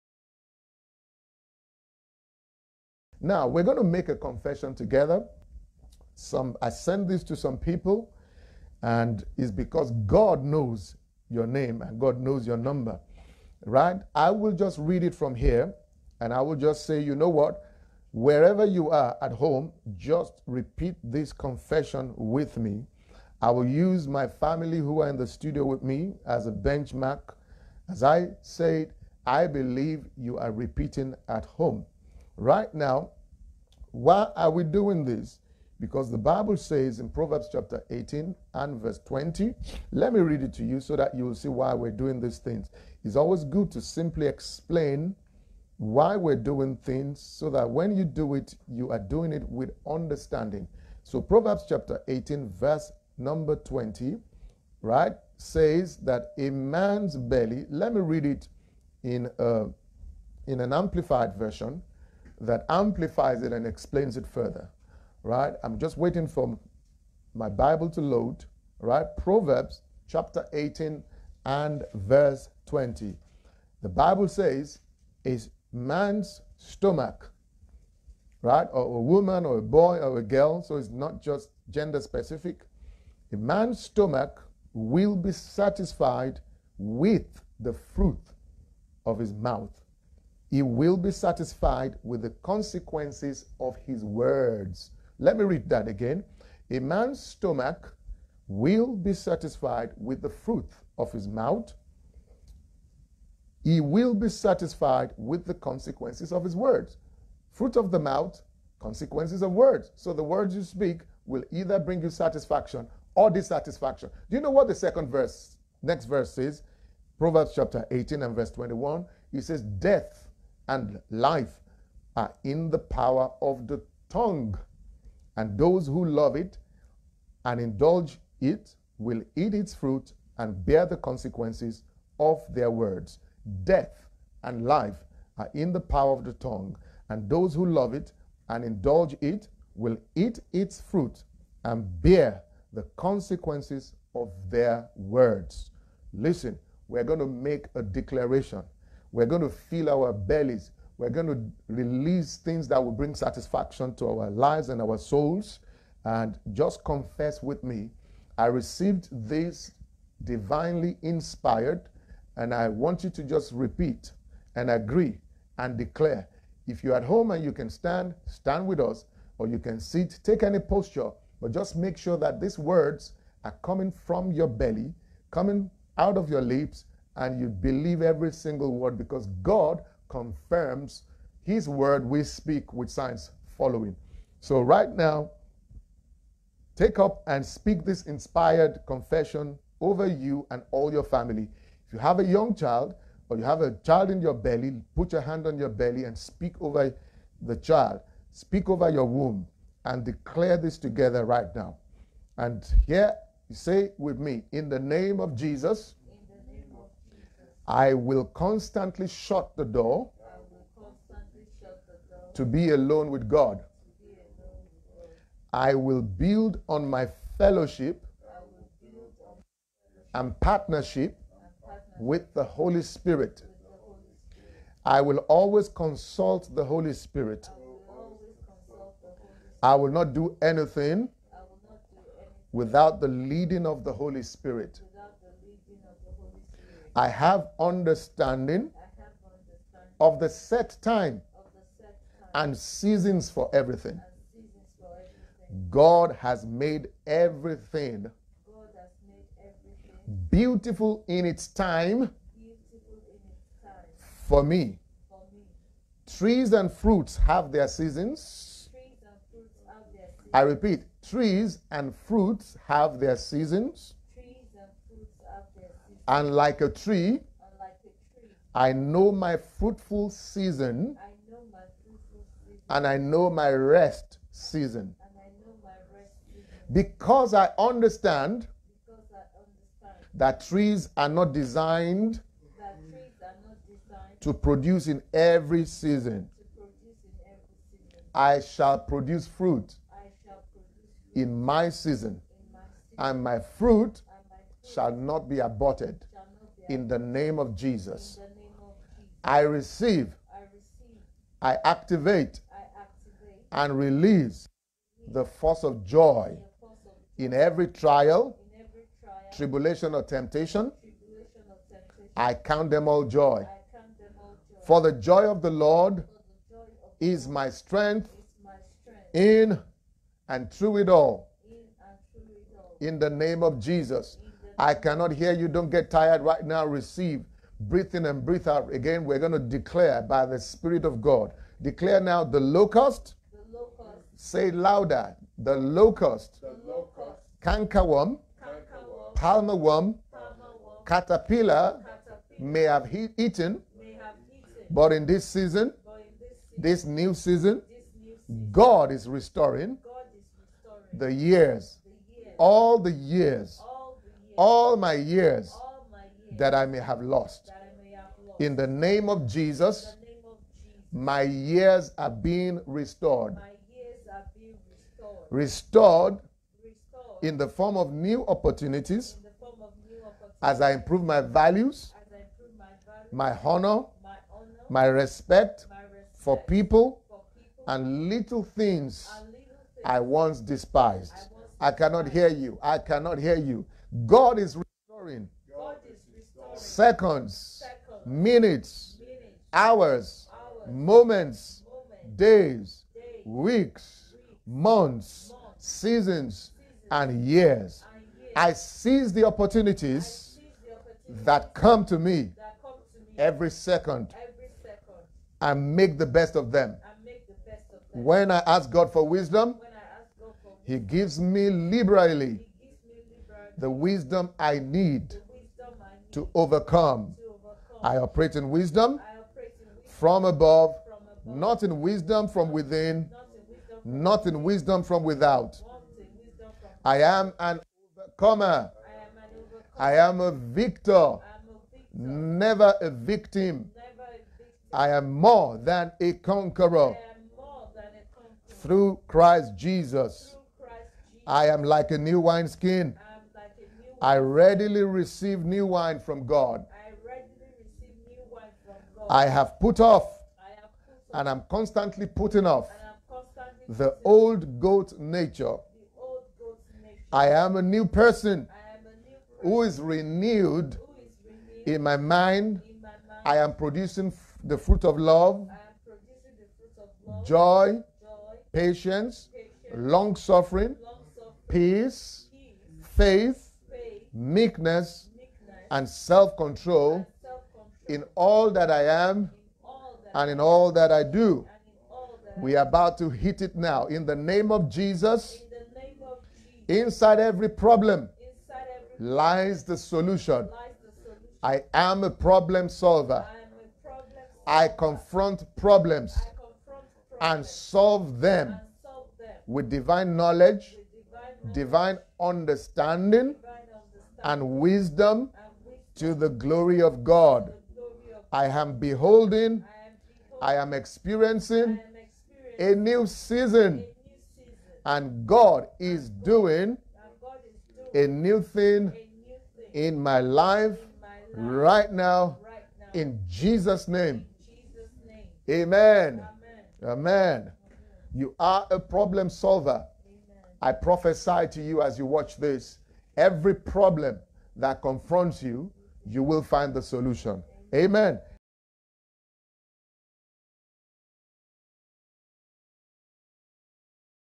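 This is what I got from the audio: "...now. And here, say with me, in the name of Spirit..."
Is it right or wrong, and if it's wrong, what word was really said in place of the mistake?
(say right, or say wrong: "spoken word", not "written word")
wrong: "Jesus", not "Spirit".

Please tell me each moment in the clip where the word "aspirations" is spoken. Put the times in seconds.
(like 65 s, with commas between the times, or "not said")
not said.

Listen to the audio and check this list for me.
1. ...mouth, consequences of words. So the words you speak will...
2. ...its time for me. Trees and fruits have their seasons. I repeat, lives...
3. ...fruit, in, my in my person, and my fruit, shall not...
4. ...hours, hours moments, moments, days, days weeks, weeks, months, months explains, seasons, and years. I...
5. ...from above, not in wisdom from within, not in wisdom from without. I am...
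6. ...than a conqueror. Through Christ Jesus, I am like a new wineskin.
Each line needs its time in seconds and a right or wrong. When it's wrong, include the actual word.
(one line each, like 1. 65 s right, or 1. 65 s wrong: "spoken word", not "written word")
1. 107 s right
2. 251 s wrong: "trees", not "lives"
3. 289 s wrong: "season", not "person"
4. 389 s wrong: "seasons", not "explains"
5. 419 s right
6. 435 s right.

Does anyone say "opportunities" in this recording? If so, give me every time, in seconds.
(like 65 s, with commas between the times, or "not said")
368 s, 399 s.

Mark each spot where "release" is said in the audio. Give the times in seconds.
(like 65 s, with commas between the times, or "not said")
151 s, 303 s.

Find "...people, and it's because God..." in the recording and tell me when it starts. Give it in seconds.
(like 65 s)
7 s.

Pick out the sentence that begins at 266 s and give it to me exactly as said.
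And like a tree, I, know my fruitful season, and I know my rest season.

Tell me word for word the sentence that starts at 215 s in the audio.
I will build on my fellowship, on and, partnership and partnership with the Holy Spirit.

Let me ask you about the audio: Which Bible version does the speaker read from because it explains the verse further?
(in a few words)
Amplified version.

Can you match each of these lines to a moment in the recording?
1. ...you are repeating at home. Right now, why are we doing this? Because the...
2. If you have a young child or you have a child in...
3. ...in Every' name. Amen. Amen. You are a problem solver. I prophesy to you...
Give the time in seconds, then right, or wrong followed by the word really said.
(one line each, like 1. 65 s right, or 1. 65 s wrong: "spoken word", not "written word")
1. 30 s right
2. 191 s right
3. 522 s wrong: "Jesus", not "Every".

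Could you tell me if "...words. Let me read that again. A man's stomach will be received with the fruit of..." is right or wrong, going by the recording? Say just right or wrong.
wrong.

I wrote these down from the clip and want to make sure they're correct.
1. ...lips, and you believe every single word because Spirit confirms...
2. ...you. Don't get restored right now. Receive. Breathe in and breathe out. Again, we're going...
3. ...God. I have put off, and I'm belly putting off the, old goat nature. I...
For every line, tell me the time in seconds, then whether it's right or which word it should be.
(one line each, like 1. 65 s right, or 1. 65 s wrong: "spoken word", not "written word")
1. 176 s wrong: "God", not "Spirit"
2. 325 s wrong: "tired", not "restored"
3. 448 s wrong: "constantly", not "belly".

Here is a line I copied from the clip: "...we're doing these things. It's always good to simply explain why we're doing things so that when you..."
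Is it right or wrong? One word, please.
right.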